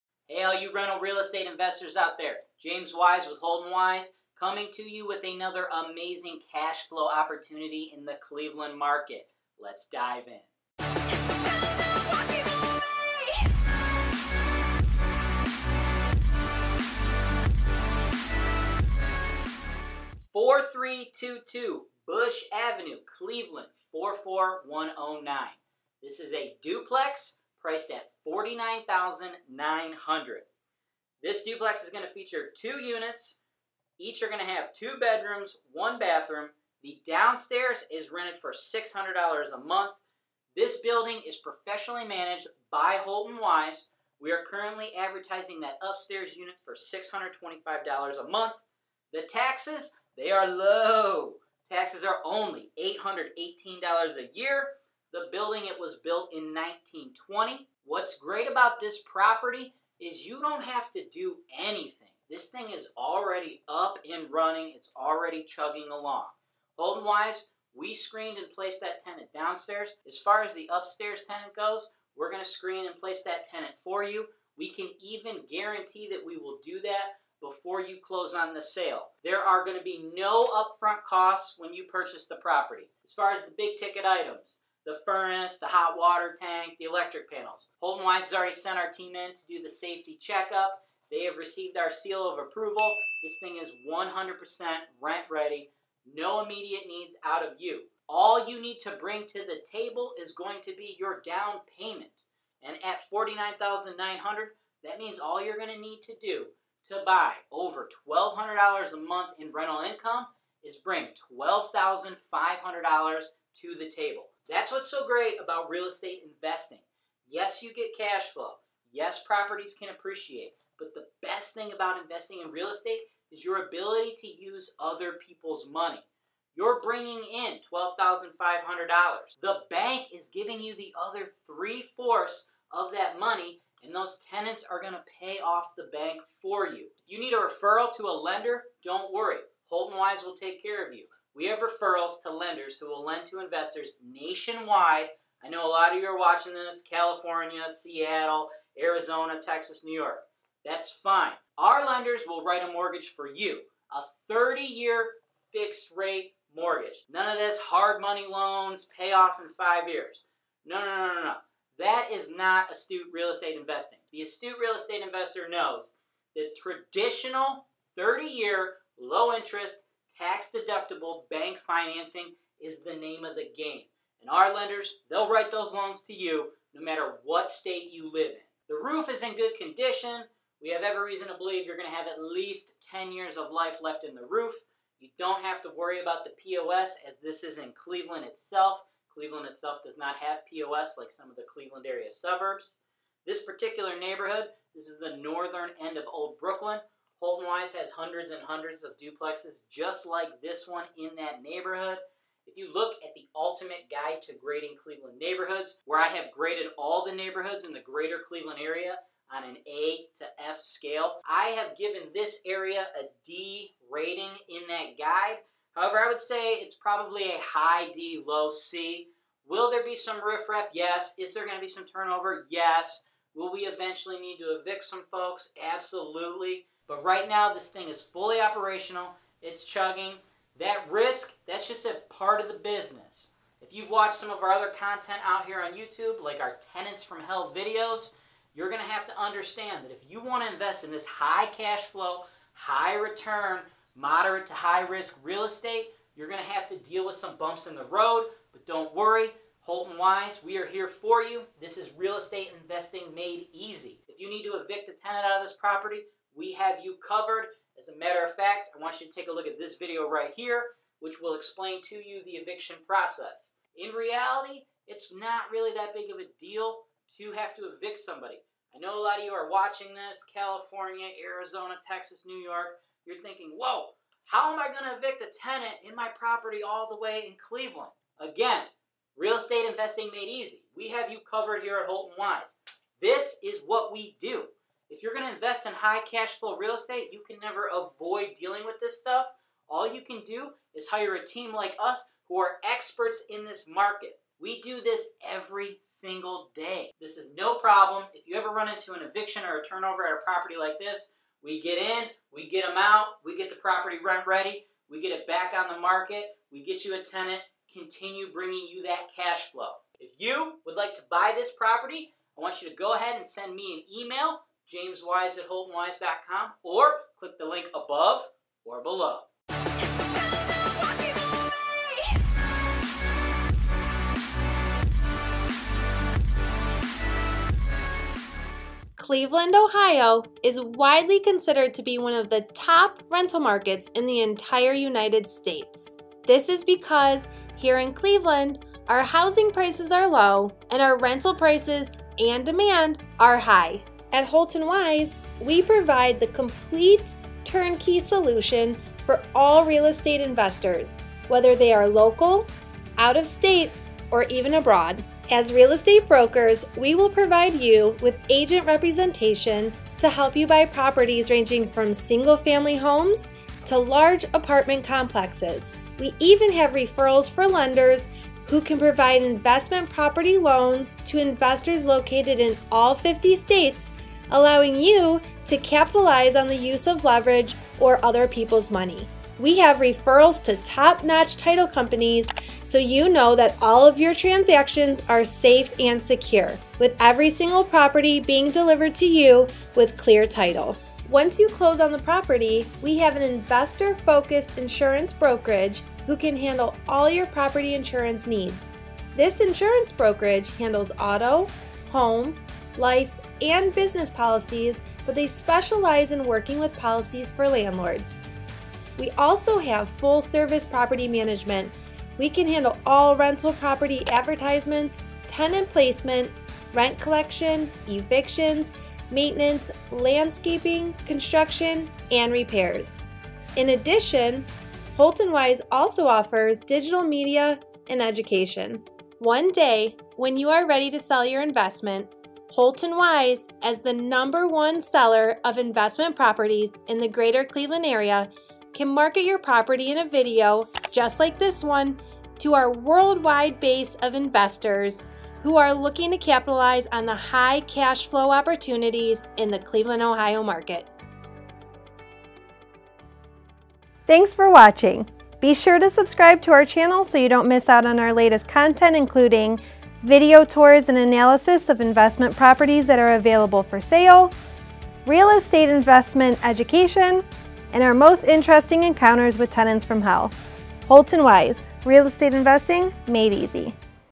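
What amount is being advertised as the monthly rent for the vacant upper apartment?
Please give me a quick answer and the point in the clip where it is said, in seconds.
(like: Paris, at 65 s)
$625, at 46 s.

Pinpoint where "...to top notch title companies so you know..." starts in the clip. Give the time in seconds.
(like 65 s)
380 s.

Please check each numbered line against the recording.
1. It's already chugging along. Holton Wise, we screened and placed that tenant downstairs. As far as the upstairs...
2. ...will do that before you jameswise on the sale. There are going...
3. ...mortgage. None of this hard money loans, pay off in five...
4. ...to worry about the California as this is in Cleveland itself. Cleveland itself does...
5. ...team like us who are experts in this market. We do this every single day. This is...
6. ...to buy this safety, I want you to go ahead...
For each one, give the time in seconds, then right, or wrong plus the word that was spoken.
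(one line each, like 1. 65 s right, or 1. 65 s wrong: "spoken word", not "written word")
1. 64 s right
2. 76 s wrong: "close", not "jameswise"
3. 156 s right
4. 185 s wrong: "POS", not "California"
5. 291 s right
6. 310 s wrong: "property", not "safety".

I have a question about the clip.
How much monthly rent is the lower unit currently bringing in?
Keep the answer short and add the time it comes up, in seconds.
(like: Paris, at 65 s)
$600, at 38 s.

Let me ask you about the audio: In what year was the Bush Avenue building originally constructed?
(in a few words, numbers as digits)
1920.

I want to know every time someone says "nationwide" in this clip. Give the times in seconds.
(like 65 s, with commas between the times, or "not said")
144 s.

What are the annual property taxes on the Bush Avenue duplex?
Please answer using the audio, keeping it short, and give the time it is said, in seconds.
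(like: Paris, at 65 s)
$818, at 52 s.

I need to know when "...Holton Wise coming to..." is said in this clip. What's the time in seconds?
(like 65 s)
3 s.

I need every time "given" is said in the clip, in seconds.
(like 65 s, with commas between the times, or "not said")
211 s.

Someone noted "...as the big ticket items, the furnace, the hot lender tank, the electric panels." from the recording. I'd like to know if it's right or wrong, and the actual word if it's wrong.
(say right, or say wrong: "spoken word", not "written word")
wrong: "water", not "lender".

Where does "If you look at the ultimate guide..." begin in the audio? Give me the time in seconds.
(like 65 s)
202 s.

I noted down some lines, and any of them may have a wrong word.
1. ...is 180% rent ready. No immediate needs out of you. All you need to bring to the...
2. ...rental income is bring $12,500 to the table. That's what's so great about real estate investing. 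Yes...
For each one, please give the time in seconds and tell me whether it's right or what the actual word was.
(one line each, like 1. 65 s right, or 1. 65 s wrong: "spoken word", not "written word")
1. 93 s wrong: "100", not "180"
2. 109 s right.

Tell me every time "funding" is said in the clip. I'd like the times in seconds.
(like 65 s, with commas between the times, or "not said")
not said.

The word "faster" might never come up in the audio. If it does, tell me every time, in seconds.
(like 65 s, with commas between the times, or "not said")
not said.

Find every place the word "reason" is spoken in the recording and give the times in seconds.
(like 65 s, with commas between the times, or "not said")
181 s.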